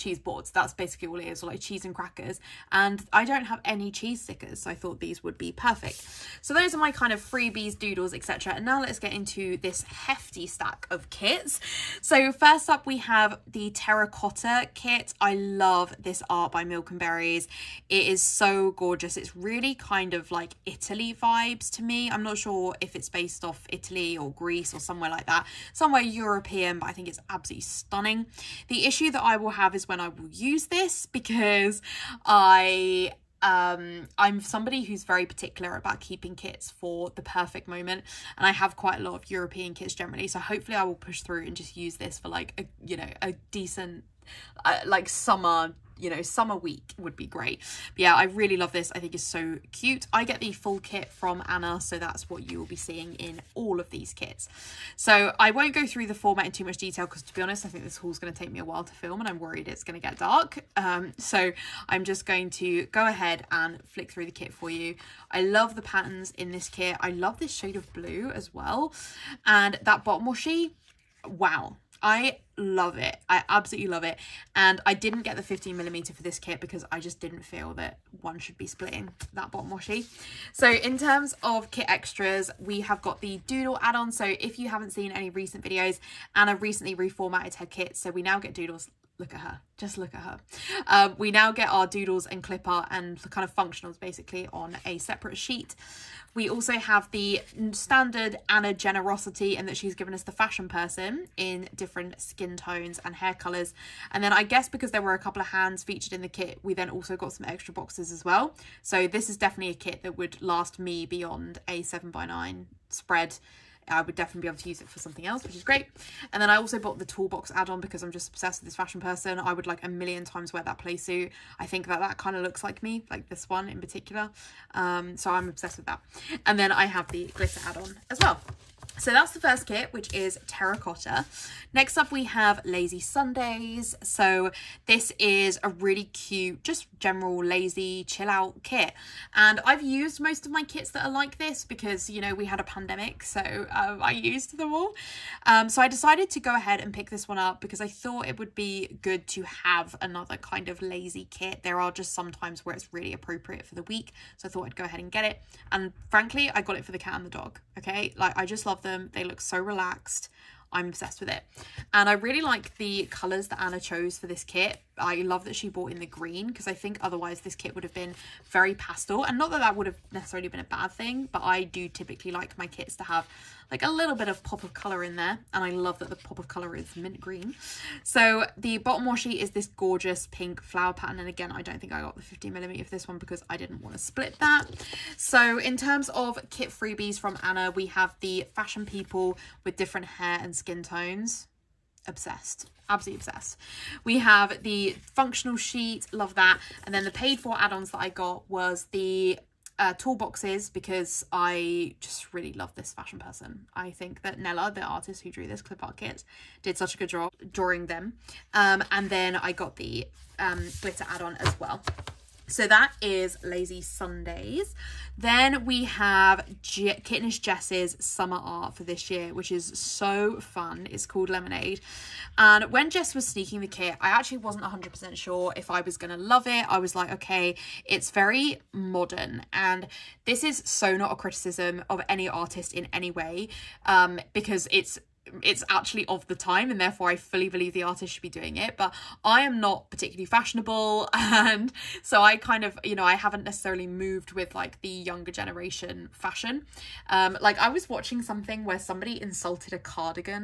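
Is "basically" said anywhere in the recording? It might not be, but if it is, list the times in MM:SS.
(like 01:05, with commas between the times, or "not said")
00:00, 01:33.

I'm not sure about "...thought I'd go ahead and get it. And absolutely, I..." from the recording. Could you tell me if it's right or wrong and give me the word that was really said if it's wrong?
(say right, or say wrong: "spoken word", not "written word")
wrong: "frankly", not "absolutely".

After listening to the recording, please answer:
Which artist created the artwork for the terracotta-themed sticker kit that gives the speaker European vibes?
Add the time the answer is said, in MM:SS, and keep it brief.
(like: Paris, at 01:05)
Milk and Berries, at 00:16.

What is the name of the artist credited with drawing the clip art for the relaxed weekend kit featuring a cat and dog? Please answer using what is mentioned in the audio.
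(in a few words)
Nella.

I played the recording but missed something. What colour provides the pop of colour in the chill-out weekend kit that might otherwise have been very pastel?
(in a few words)
Mint green.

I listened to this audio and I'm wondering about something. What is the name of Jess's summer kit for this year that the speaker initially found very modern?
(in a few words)
Lemonade.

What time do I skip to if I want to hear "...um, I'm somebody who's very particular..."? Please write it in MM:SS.
00:33.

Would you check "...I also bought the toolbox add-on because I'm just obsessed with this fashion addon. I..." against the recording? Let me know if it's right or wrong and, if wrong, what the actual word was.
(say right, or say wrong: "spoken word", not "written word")
wrong: "person", not "addon".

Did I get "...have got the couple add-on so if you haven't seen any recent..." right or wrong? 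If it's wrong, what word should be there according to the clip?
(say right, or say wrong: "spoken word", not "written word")
wrong: "doodle", not "couple".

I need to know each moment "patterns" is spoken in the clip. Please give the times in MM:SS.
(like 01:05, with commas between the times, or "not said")
01:05, 03:00.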